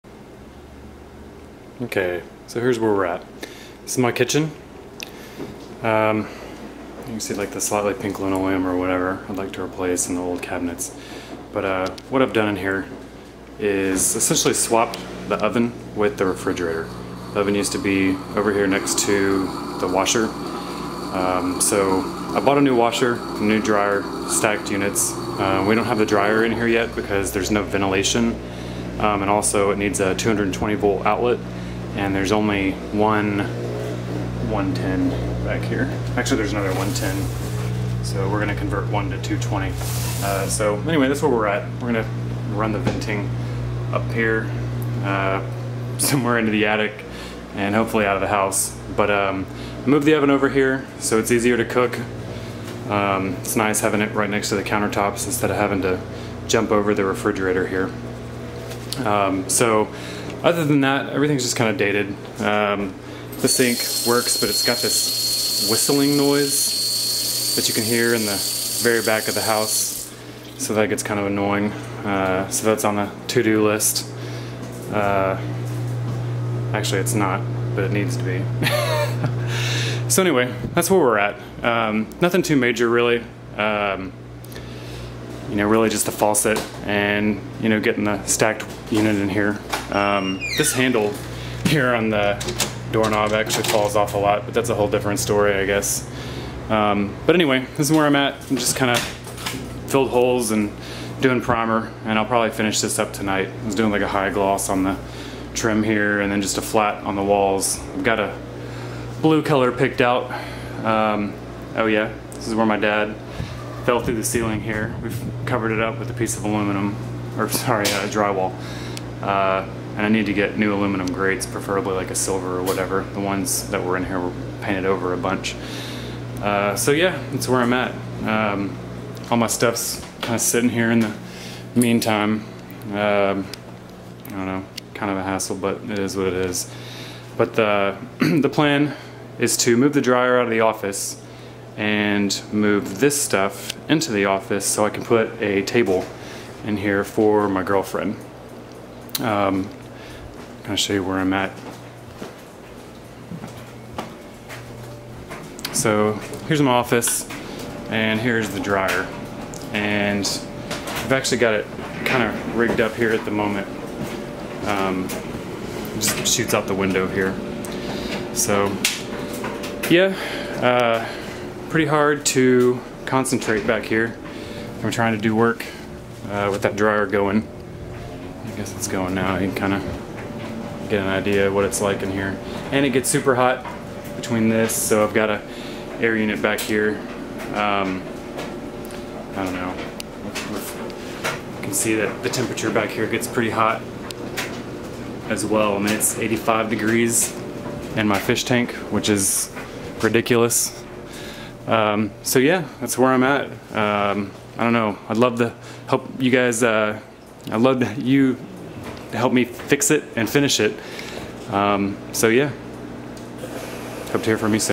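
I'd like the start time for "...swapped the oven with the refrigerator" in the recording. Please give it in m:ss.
0:14.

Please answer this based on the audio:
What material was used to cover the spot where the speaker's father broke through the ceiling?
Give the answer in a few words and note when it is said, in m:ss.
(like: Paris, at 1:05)
drywall, at 1:58.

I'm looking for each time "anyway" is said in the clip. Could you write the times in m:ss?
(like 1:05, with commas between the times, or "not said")
0:40, 1:20, 1:37.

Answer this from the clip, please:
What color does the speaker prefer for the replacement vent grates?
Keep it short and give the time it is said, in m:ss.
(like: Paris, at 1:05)
silver, at 2:02.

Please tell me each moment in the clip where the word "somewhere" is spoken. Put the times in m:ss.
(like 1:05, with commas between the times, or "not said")
0:45.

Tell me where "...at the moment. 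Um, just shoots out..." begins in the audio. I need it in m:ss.
2:43.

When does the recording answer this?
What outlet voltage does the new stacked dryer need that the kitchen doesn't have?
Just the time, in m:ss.
0:30.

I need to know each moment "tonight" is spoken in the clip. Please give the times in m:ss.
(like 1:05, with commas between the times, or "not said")
1:43.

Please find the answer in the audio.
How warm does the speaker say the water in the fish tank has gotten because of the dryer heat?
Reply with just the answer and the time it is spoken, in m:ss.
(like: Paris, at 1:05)
85 degrees, at 3:16.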